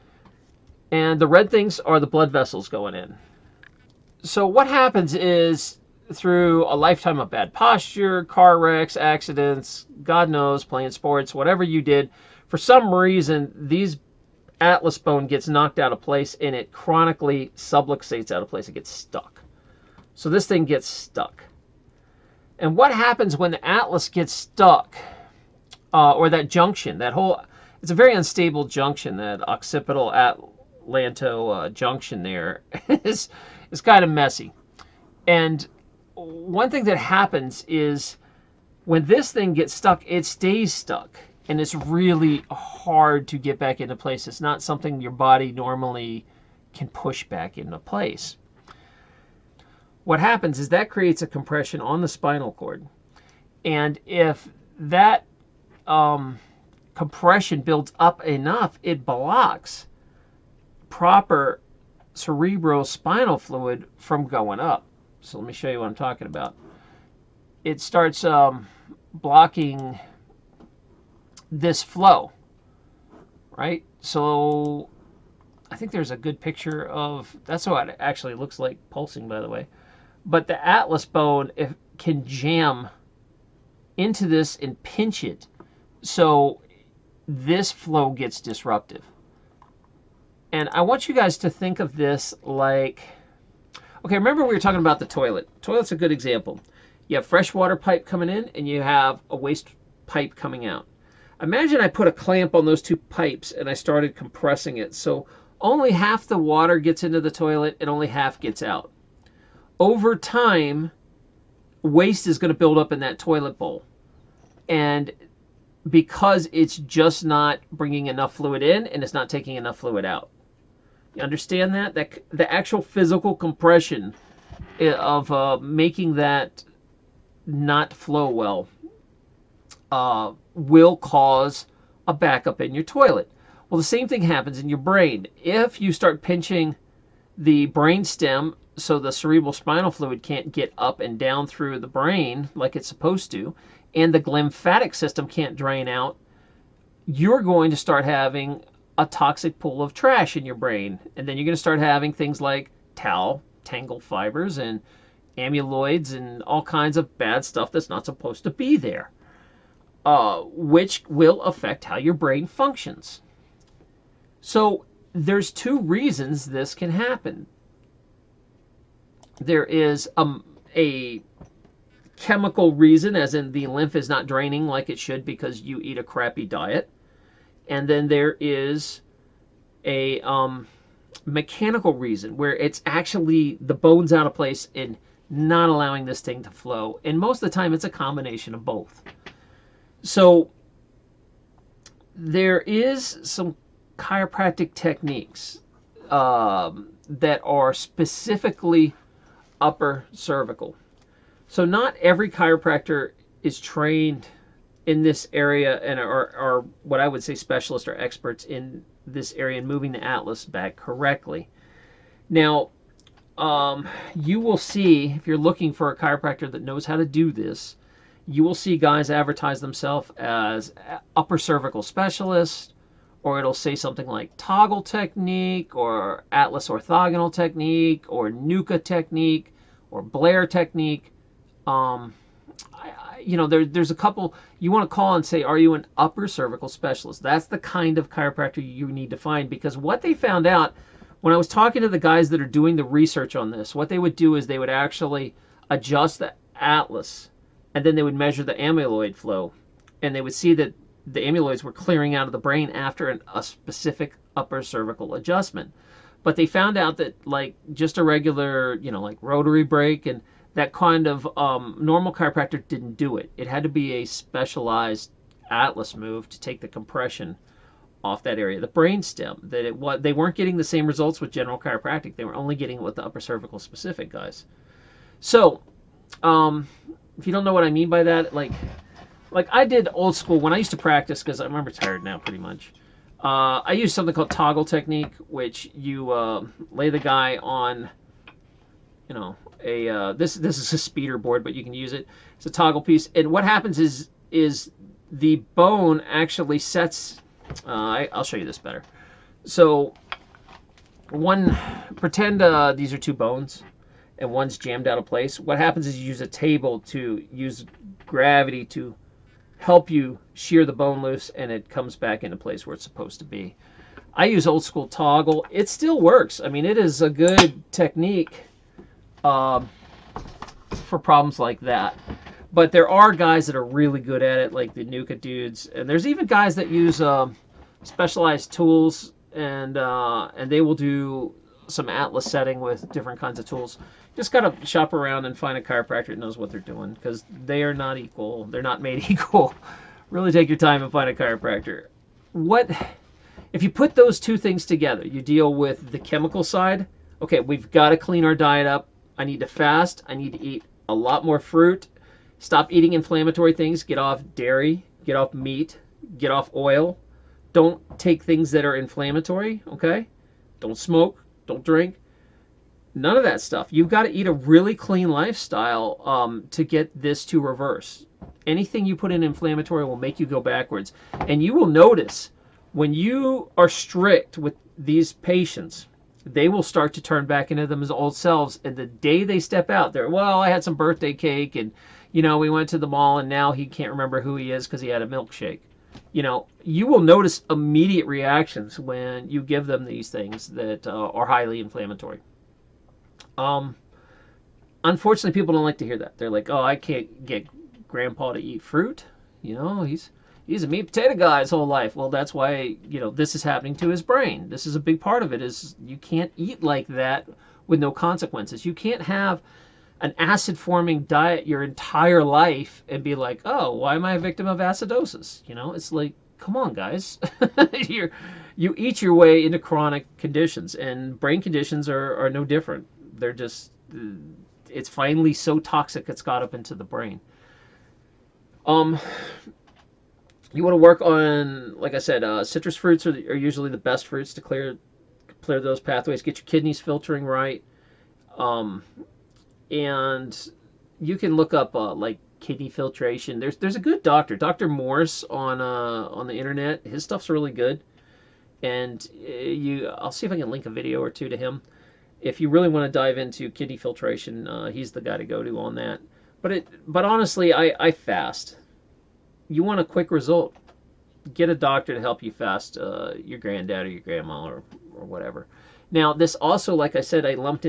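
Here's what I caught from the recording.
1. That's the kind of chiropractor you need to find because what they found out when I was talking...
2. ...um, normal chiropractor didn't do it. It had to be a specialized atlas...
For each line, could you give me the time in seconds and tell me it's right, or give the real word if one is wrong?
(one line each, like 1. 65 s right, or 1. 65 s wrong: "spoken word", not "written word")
1. 237 s right
2. 261 s right.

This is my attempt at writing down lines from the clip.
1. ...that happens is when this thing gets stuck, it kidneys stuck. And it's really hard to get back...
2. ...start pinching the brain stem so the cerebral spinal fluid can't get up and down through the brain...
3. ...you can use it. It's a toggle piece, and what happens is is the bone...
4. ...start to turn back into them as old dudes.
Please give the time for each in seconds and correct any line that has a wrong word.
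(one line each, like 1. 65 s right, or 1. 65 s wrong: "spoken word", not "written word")
1. 36 s wrong: "stays", not "kidneys"
2. 135 s right
3. 291 s right
4. 376 s wrong: "selves", not "dudes".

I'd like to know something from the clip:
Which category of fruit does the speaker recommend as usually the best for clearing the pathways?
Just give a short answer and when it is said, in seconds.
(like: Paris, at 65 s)
Citrus fruits, at 432 s.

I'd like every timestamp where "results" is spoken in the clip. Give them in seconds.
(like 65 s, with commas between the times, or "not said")
270 s, 460 s.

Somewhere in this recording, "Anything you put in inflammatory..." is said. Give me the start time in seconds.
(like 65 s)
368 s.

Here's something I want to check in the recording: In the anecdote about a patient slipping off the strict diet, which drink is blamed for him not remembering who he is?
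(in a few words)
A milkshake.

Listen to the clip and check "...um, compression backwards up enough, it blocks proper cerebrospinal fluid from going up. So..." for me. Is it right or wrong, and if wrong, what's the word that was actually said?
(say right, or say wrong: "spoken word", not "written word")
wrong: "builds", not "backwards".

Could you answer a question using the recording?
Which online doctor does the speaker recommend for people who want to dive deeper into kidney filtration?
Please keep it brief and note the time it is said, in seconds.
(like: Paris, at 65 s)
Doctor Morse, at 444 s.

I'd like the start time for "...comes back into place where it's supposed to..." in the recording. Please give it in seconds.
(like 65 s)
311 s.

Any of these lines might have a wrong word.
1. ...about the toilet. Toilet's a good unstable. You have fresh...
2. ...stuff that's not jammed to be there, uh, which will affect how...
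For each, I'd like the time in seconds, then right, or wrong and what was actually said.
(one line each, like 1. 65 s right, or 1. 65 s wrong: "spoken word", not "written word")
1. 94 s wrong: "example", not "unstable"
2. 157 s wrong: "supposed", not "jammed".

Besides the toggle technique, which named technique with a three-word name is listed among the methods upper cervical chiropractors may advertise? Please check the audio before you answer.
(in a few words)
Atlas orthogonal technique.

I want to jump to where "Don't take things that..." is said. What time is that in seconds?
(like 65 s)
357 s.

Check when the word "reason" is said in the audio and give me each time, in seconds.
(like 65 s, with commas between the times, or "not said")
12 s, 165 s, 172 s, 181 s.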